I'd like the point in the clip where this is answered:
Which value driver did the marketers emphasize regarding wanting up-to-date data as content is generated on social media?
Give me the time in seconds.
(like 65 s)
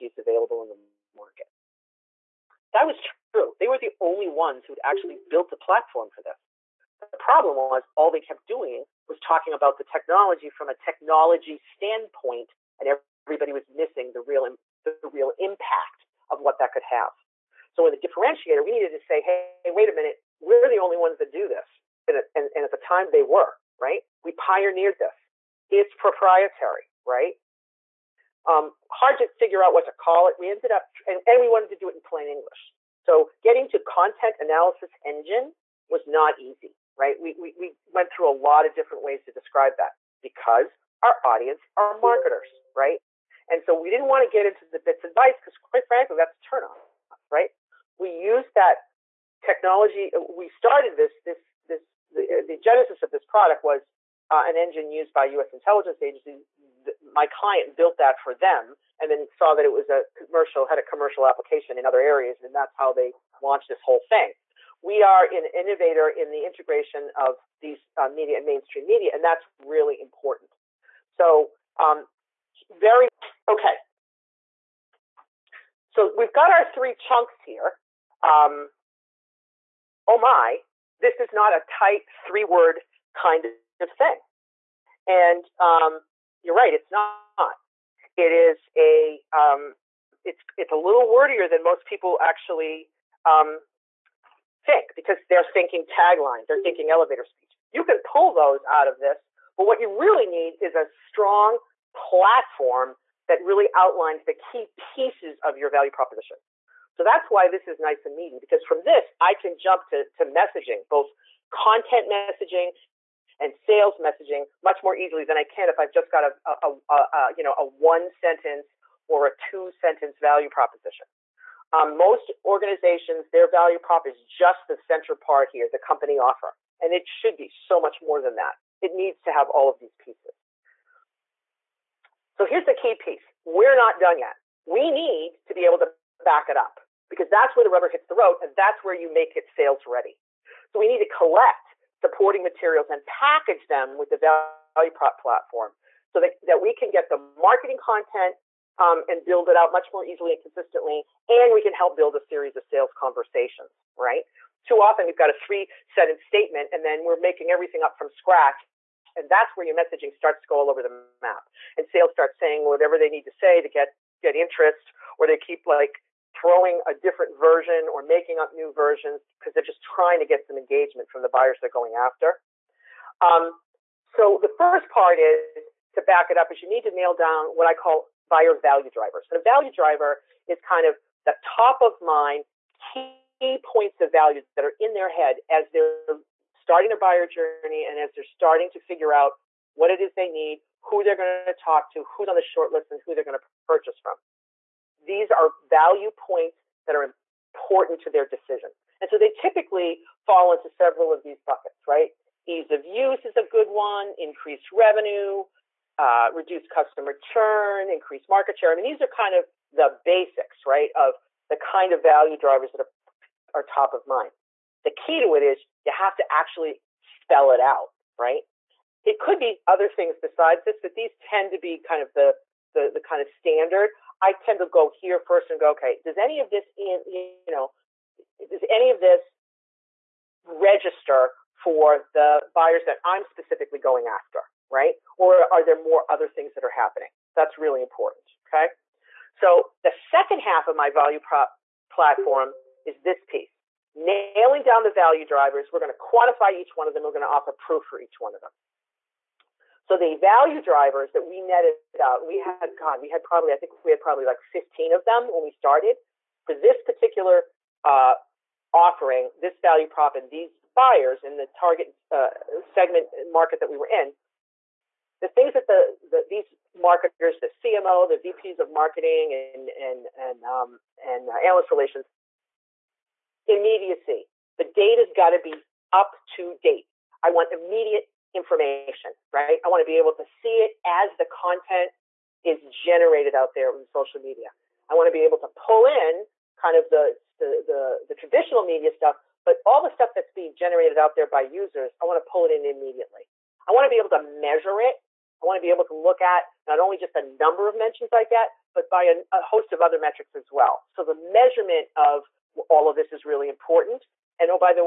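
273 s.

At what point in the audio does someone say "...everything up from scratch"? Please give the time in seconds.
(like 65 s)
157 s.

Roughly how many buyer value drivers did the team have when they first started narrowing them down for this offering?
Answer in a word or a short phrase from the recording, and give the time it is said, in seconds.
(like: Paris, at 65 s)
15, at 254 s.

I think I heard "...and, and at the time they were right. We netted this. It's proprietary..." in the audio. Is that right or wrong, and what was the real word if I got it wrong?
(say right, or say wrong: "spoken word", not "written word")
wrong: "pioneered", not "netted".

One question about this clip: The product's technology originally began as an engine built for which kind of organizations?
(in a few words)
U.S. intelligence agencies.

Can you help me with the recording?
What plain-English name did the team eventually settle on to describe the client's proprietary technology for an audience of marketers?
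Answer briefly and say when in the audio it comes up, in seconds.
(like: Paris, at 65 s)
content analysis engine, at 33 s.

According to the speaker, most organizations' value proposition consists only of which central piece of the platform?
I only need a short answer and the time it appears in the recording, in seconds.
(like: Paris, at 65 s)
the company offer, at 125 s.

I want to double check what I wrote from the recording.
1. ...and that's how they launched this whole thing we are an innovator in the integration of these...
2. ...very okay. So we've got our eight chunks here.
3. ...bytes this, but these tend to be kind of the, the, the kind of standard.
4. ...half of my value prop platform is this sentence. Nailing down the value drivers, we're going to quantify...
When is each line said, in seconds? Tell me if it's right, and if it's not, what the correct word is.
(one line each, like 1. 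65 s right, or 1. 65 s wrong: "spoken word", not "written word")
1. 62 s right
2. 72 s wrong: "three", not "eight"
3. 220 s wrong: "besides", not "bytes"
4. 240 s wrong: "piece", not "sentence".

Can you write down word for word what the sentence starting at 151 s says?
And we can help build a series of sales conversations, right?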